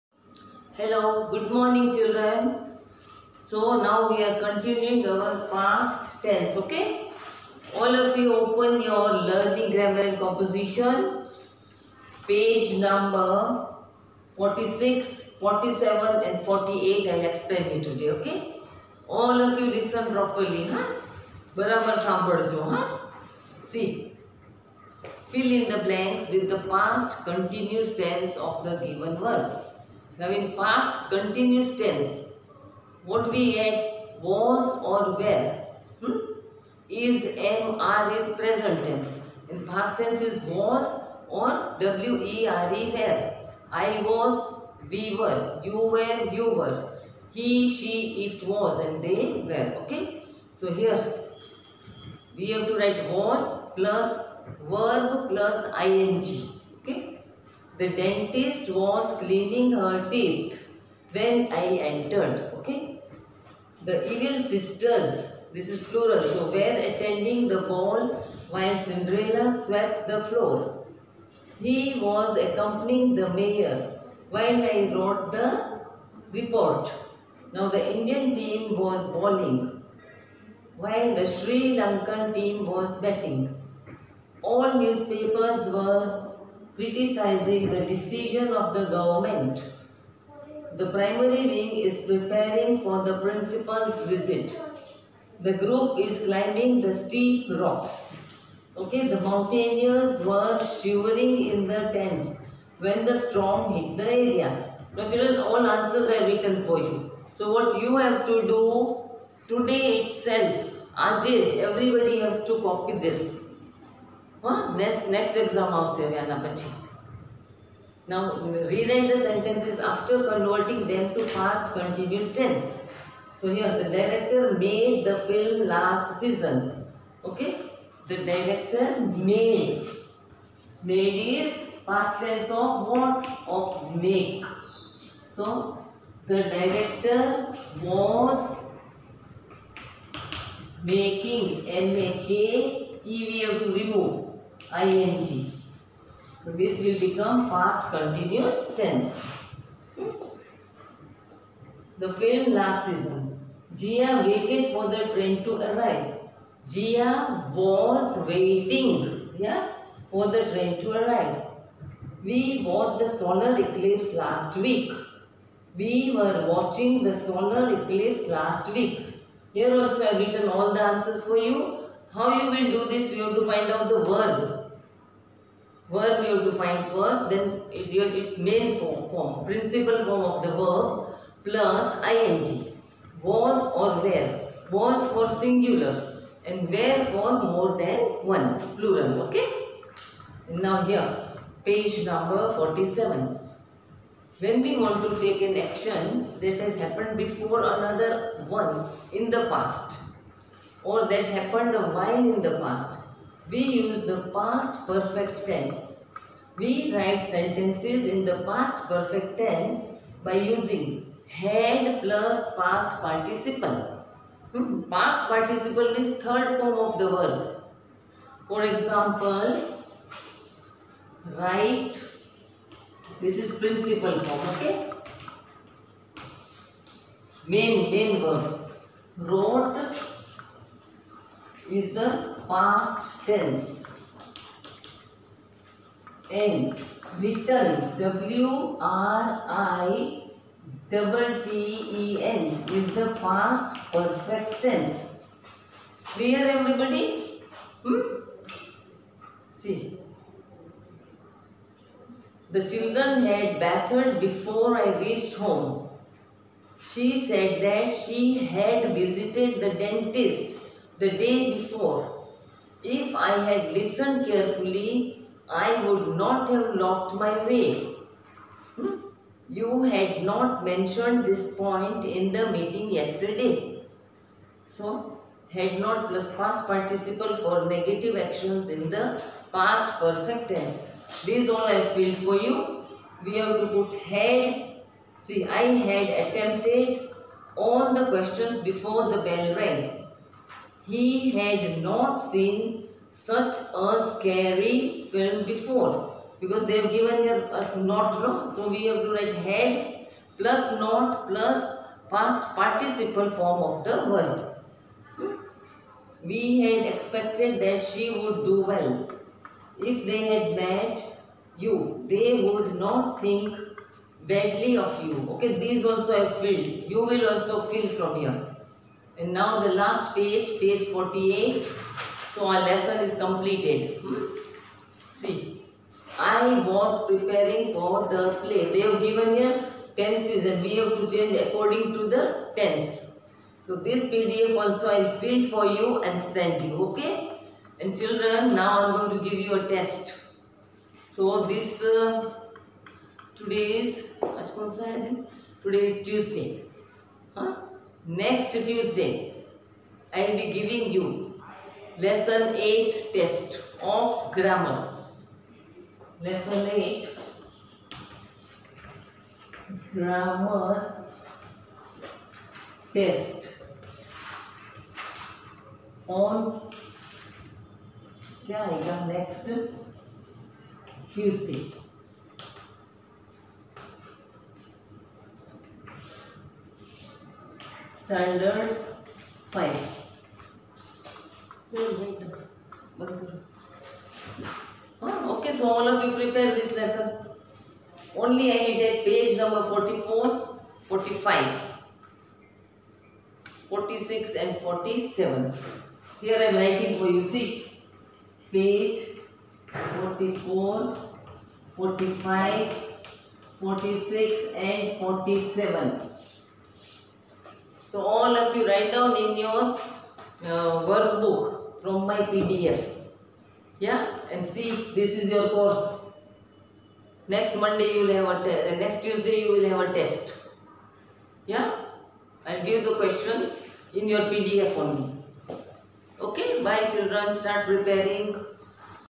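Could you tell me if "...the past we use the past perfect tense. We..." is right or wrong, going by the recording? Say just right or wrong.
right.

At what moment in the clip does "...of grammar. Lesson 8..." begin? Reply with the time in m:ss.
5:53.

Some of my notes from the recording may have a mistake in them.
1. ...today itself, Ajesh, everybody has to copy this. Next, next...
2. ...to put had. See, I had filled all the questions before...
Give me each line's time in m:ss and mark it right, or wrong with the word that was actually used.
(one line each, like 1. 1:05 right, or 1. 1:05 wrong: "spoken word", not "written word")
1. 1:49 right
2. 4:43 wrong: "attempted", not "filled".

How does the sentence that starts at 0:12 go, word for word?
Page number 46, 47 and 48 I'll explain it today, okay?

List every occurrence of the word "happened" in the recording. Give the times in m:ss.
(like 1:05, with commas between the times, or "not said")
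3:16, 3:21.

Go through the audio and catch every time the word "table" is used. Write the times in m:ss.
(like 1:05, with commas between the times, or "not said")
not said.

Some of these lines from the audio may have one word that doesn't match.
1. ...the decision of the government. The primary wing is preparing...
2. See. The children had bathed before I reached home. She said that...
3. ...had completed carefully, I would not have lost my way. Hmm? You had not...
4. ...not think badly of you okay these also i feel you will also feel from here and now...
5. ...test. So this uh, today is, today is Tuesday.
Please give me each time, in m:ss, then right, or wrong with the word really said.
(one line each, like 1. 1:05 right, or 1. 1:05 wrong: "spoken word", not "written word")
1. 1:27 right
2. 4:09 right
3. 4:23 wrong: "listened", not "completed"
4. 5:12 right
5. 5:39 right.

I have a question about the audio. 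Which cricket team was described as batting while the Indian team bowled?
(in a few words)
Sri Lankan team.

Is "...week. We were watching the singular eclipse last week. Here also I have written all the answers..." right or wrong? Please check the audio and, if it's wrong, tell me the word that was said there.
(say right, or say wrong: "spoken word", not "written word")
wrong: "solar", not "singular".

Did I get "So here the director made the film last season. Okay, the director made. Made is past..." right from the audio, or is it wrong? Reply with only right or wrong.
right.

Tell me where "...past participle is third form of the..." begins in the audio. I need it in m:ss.
3:34.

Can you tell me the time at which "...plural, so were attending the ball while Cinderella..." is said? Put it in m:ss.
1:05.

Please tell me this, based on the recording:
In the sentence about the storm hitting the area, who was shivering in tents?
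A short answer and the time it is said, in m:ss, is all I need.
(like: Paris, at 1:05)
the mountaineers, at 1:39.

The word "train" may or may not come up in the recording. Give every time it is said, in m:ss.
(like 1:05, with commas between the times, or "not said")
2:35, 2:40.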